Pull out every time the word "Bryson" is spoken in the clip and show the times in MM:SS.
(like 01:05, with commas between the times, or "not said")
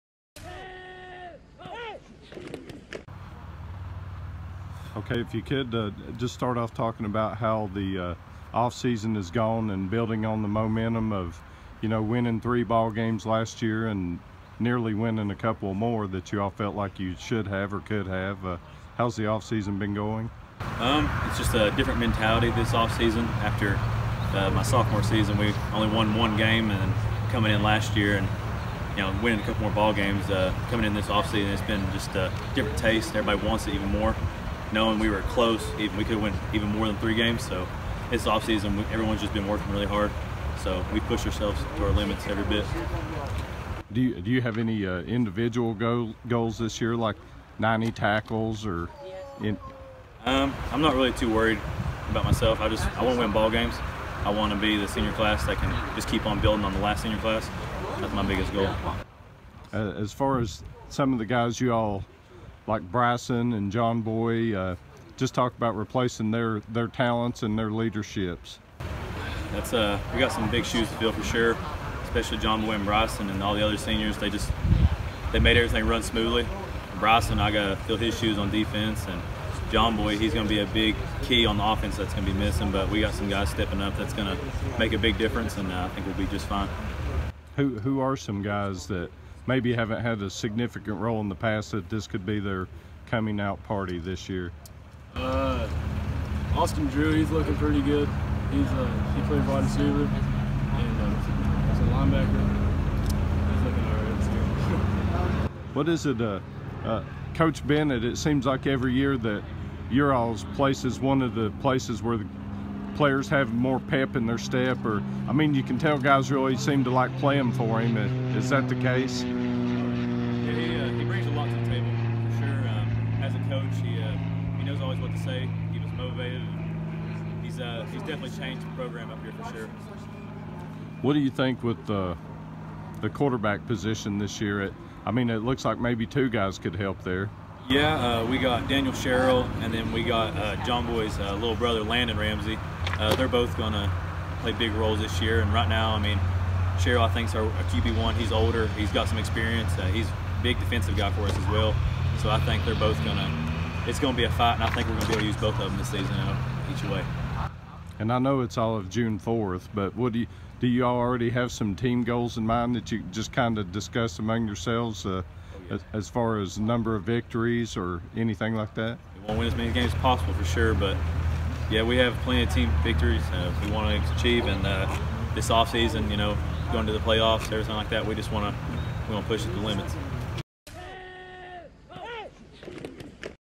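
01:02, 01:12, 01:16.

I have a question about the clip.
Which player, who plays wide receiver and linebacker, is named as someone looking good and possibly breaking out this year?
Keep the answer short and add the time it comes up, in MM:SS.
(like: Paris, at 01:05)
Austin Drew, at 01:36.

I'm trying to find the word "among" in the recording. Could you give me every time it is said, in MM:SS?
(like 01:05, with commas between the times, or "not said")
02:44.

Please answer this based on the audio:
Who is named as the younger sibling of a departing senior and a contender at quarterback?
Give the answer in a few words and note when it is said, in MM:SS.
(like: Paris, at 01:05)
Landon Ramsey, at 02:21.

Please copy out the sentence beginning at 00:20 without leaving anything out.
Um, it's just a different mentality this off season.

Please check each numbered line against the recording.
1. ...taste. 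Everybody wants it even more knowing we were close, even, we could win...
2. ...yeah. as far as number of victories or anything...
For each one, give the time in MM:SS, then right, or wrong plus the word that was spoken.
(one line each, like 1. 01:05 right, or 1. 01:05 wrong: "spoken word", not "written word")
1. 00:32 right
2. 02:45 right.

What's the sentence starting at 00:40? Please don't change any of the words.
So we push ourselves to our limits every bit.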